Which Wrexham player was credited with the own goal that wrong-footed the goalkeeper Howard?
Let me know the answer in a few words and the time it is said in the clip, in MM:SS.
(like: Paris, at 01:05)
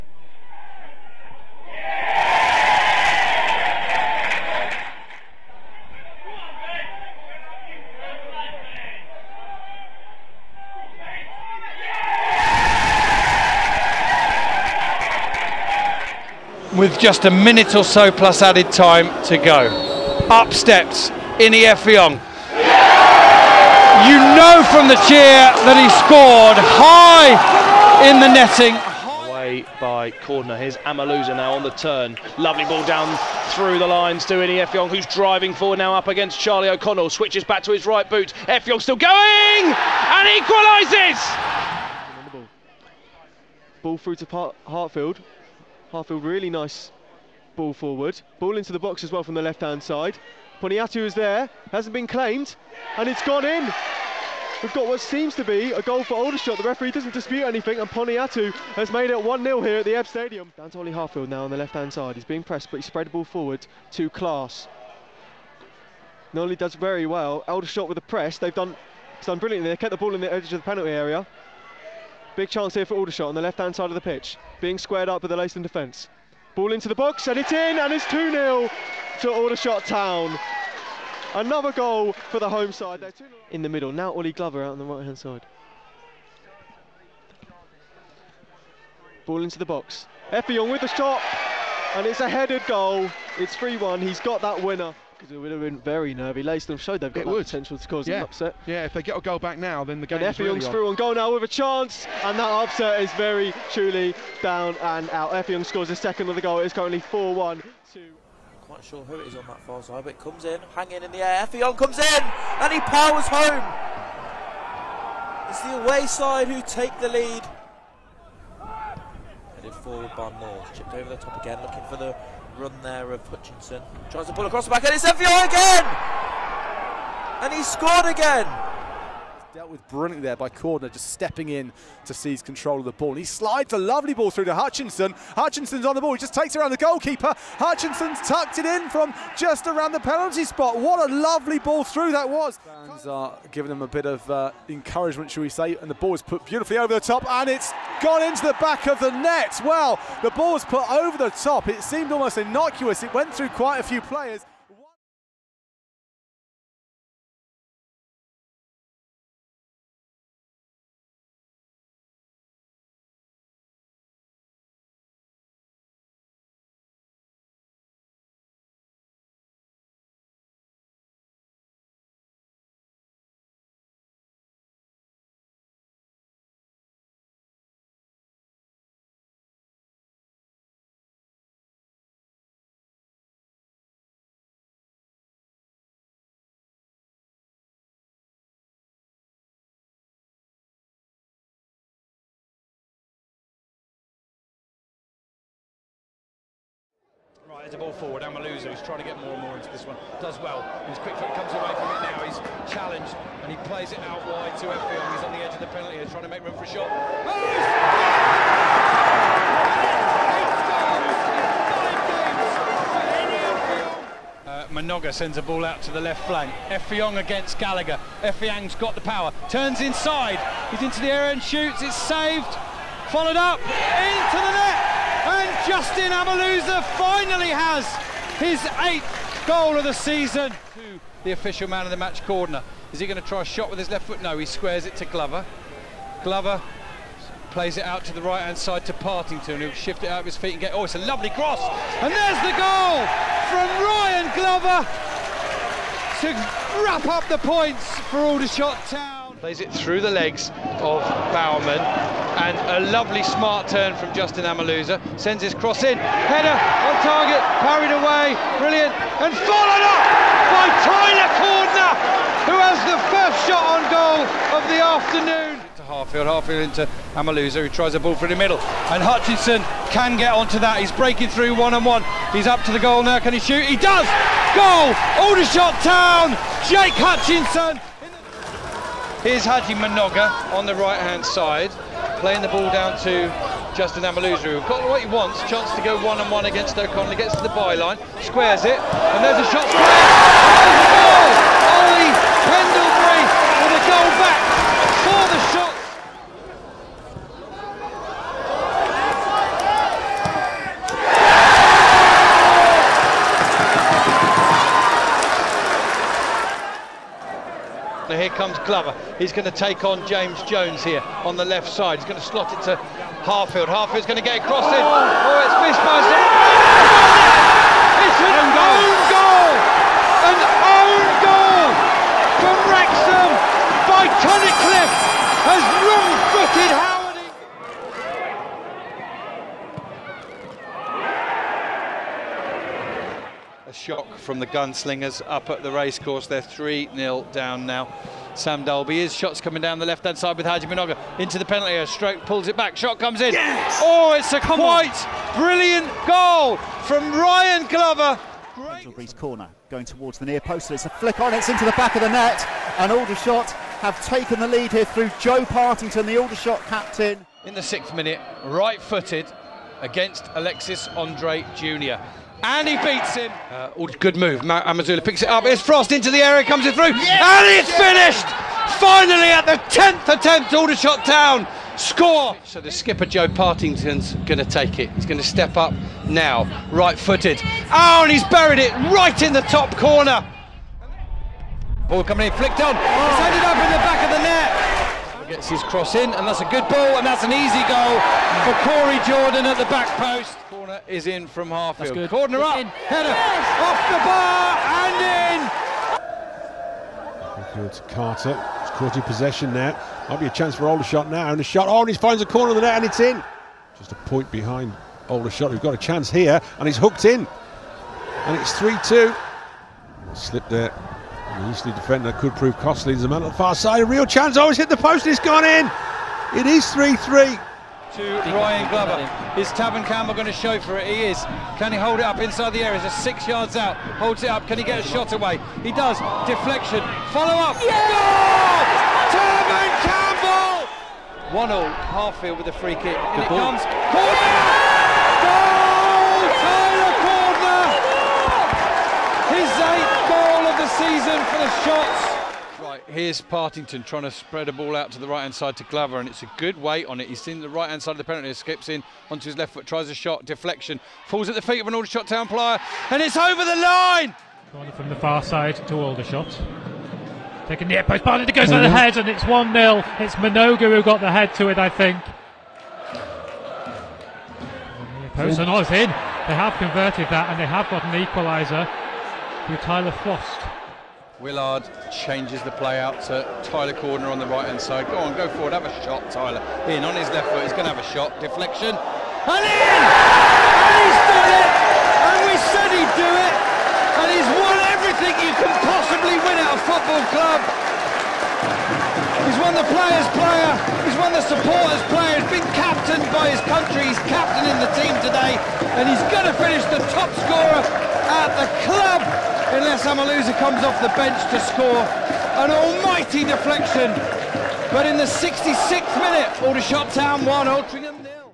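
Tunnicliffe, at 05:24.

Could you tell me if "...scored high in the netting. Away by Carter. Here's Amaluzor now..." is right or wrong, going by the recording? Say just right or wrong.
wrong.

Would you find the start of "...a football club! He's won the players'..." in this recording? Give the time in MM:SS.
08:06.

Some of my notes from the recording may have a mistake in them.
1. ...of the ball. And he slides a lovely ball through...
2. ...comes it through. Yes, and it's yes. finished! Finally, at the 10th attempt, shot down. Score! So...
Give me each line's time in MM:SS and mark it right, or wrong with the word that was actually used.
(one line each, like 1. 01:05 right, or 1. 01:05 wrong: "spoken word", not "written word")
1. 02:12 right
2. 06:06 right.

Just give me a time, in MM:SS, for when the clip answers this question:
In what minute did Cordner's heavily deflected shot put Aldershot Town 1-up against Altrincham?
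08:25.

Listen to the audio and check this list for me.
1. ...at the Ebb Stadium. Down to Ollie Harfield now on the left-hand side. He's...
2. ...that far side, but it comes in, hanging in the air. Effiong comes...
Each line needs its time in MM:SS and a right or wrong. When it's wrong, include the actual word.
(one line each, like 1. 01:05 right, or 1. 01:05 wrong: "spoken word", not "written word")
1. 00:59 right
2. 01:49 right.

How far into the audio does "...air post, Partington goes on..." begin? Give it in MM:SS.
07:37.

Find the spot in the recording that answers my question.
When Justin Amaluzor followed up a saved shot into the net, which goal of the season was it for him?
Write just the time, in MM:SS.
03:48.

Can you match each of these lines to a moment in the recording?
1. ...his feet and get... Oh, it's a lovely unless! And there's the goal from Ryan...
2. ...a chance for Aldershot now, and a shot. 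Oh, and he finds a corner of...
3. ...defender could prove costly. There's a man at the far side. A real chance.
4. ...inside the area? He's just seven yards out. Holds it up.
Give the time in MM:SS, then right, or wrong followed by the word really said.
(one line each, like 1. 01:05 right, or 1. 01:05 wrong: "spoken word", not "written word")
1. 04:00 wrong: "cross", not "unless"
2. 06:40 right
3. 06:51 right
4. 07:02 wrong: "six", not "seven".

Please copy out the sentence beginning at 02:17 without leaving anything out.
Hutchinson's tucked it in from just around the penalty spot.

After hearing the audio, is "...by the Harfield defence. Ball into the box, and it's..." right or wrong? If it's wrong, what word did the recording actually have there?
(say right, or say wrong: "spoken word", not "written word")
wrong: "Leicester", not "Harfield".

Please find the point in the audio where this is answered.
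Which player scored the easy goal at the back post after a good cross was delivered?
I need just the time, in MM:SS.
06:28.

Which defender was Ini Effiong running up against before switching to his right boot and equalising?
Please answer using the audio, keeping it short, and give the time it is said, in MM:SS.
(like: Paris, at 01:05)
Charlie O'Connell, at 00:36.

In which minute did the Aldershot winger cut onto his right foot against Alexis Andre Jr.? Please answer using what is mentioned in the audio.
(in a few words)
6th.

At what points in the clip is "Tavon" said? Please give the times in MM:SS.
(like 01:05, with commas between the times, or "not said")
06:59, 07:09.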